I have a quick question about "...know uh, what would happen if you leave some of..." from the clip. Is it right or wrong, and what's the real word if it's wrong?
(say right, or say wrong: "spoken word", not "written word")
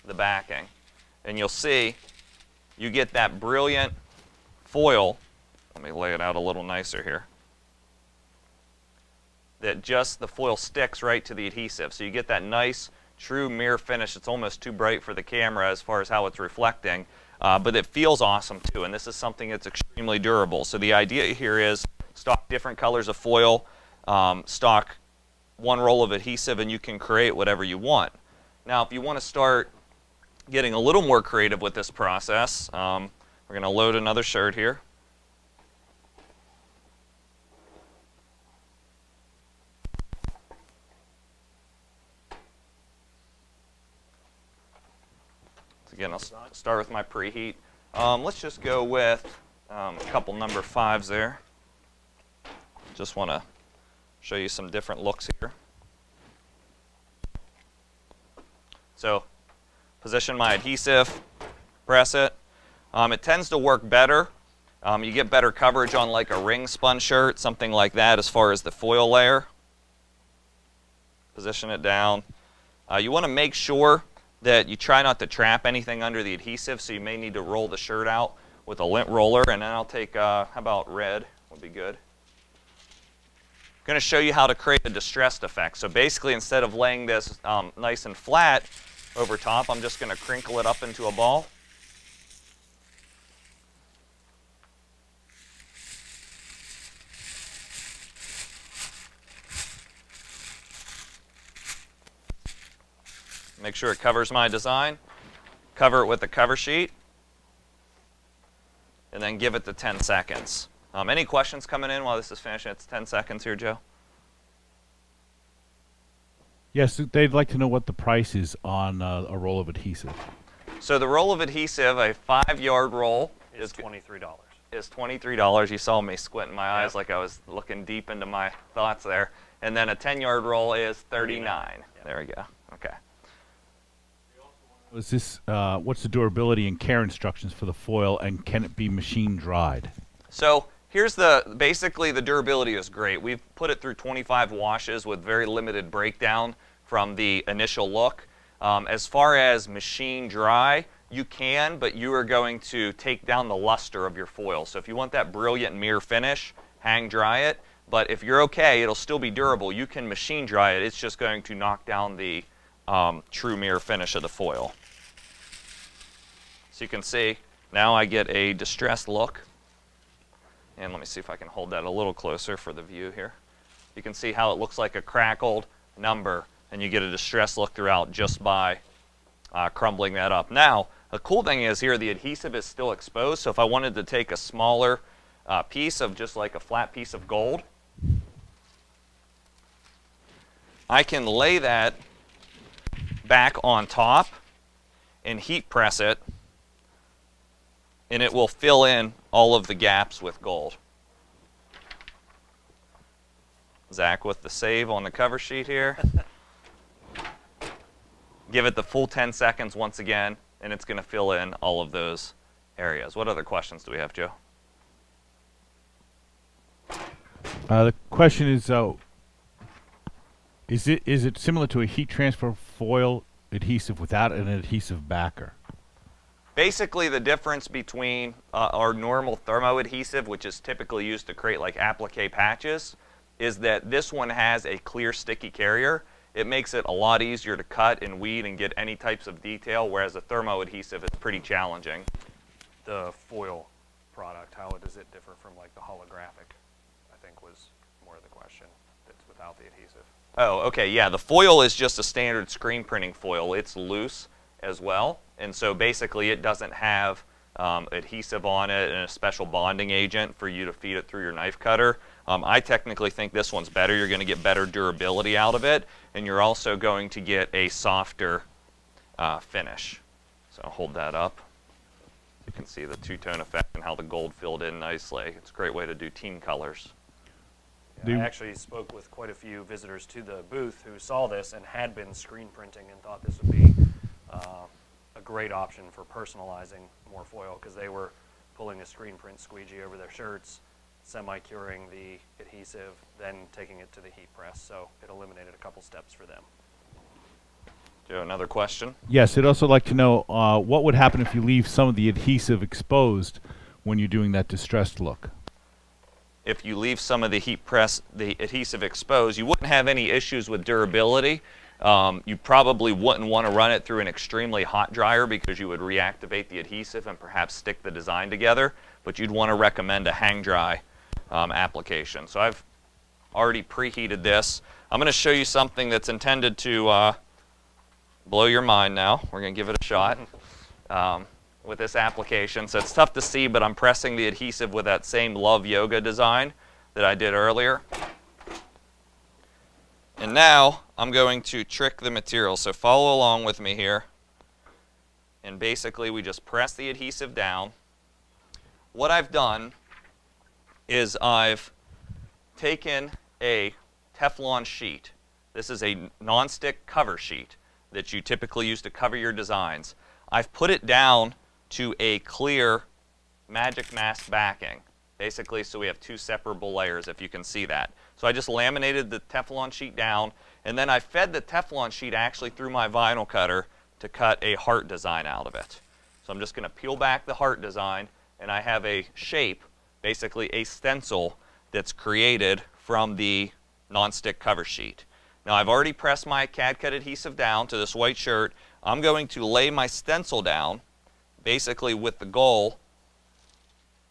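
right.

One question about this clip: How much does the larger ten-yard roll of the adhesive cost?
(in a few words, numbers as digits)
$39.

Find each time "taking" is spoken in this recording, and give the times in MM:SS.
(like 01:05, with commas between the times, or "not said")
04:53.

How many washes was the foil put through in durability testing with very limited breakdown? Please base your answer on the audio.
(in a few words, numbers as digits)
25.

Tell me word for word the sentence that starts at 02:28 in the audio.
Um, as far as machine dry, you can, but you are going to take down the luster of your foil.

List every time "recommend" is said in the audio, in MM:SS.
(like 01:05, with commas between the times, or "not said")
05:19.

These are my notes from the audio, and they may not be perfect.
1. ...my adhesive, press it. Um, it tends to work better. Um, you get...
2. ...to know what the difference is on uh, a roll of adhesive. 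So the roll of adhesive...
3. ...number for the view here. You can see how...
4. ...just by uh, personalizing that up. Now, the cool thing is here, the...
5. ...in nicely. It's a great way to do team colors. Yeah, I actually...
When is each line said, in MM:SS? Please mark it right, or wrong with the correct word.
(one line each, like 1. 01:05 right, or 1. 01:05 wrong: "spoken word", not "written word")
1. 01:00 right
2. 01:57 wrong: "price", not "difference"
3. 02:52 wrong: "closer", not "number"
4. 02:58 wrong: "crumbling", not "personalizing"
5. 04:34 right.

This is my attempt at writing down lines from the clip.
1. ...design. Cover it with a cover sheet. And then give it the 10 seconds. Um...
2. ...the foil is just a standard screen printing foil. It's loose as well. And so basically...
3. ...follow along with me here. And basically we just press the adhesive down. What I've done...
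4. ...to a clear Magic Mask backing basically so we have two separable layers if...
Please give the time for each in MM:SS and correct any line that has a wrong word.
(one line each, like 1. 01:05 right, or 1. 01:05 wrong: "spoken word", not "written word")
1. 01:44 right
2. 04:11 right
3. 05:42 right
4. 06:01 right.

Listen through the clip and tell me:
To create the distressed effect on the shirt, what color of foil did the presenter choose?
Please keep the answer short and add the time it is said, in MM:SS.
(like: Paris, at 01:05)
Red, at 01:20.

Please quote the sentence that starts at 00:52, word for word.
Just want to show you some different looks here.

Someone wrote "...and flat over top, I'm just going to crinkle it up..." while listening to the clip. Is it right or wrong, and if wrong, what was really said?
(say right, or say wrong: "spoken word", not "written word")
right.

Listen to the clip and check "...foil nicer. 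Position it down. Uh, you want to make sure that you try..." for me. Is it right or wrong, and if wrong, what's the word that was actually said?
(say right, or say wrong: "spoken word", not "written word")
wrong: "layer", not "nicer".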